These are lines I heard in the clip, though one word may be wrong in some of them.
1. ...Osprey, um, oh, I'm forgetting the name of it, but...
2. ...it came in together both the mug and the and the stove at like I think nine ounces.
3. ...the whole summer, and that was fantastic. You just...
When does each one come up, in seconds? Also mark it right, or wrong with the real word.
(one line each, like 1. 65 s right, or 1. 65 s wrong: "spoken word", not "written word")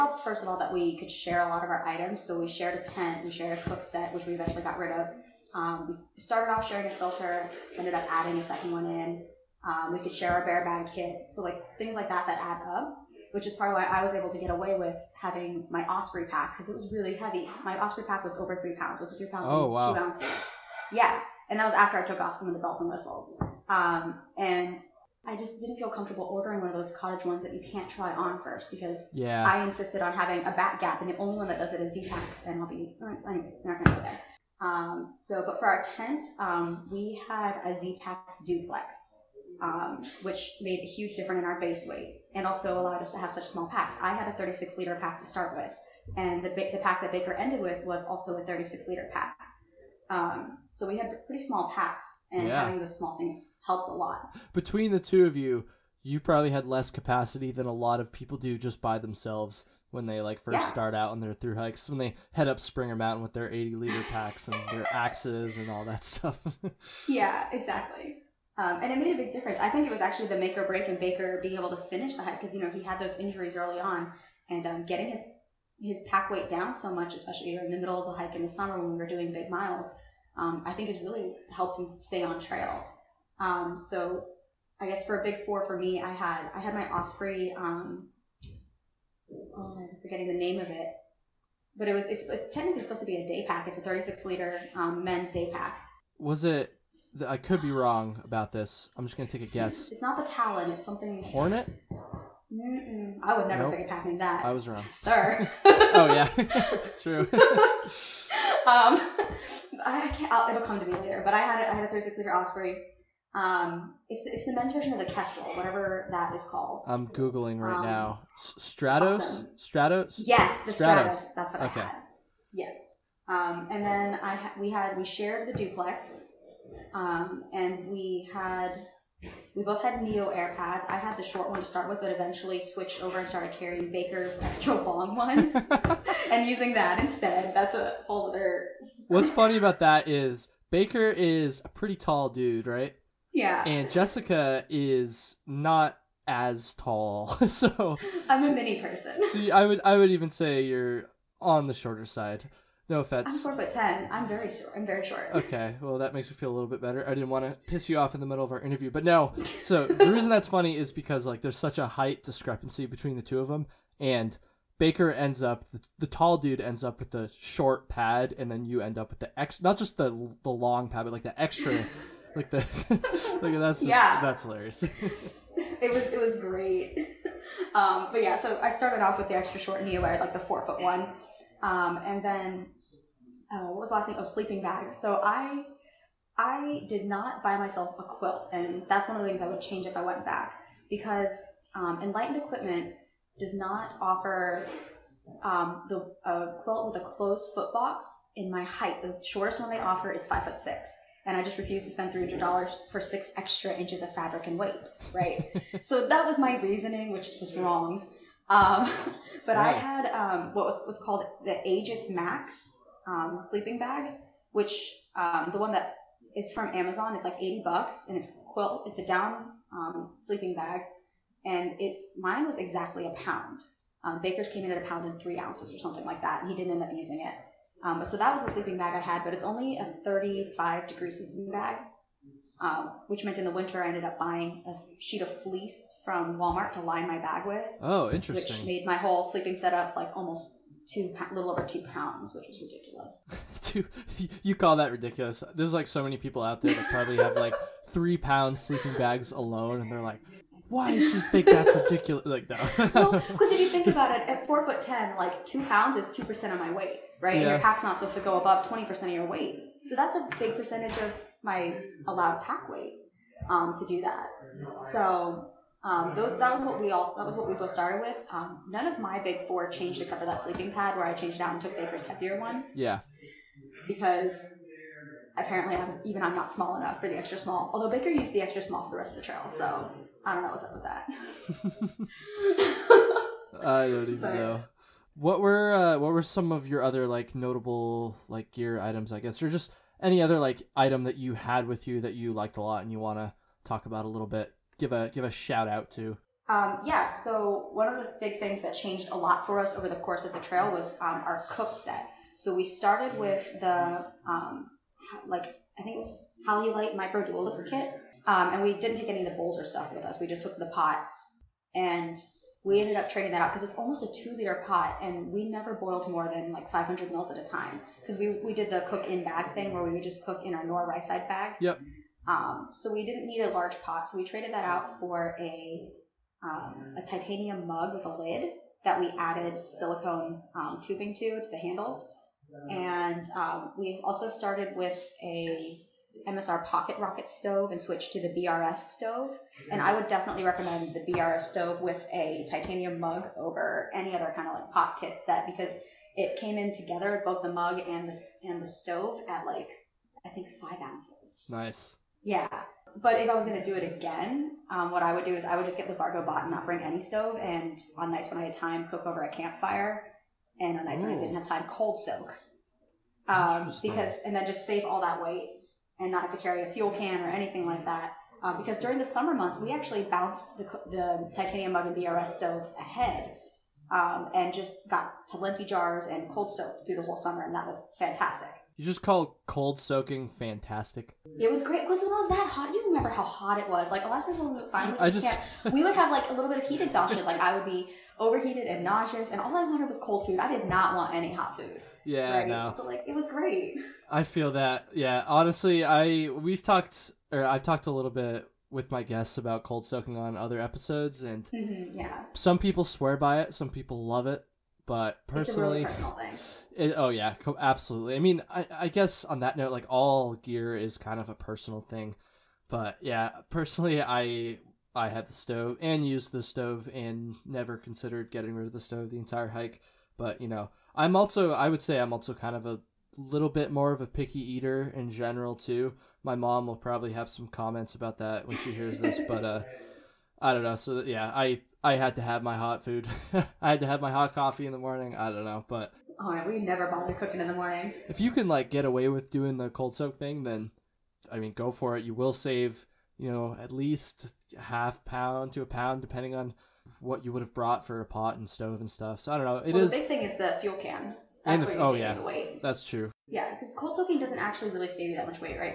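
1. 86 s right
2. 346 s wrong: "five", not "nine"
3. 376 s right.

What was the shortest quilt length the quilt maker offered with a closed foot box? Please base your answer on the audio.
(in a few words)
5 foot 6.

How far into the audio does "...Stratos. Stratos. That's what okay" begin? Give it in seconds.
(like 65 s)
120 s.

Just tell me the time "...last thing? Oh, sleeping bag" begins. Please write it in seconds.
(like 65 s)
183 s.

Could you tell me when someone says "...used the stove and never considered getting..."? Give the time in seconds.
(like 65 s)
416 s.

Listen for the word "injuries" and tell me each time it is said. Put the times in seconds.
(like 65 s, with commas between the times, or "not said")
73 s.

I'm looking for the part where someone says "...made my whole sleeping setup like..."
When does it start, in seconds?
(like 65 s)
238 s.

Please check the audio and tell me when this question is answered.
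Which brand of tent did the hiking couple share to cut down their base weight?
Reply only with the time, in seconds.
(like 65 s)
37 s.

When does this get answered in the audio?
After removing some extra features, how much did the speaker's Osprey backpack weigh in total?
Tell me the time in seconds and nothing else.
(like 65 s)
19 s.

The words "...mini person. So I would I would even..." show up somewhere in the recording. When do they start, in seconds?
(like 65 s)
148 s.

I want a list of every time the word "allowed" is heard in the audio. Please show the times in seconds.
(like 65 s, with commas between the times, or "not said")
42 s, 262 s.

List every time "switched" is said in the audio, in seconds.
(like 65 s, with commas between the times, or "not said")
132 s, 337 s.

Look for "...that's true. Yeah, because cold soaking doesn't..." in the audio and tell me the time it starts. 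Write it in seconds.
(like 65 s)
452 s.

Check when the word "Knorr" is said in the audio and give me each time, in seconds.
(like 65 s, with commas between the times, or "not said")
320 s.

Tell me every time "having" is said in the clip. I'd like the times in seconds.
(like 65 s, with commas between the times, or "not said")
15 s, 30 s, 52 s, 103 s.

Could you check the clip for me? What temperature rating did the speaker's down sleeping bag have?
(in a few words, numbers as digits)
35 degrees.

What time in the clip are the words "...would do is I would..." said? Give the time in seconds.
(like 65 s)
355 s.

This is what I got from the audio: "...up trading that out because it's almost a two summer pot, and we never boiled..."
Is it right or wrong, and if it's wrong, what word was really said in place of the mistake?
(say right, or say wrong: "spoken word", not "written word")
wrong: "liter", not "summer".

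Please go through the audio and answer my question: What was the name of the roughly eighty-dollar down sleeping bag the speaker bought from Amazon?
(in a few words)
Aegis Max.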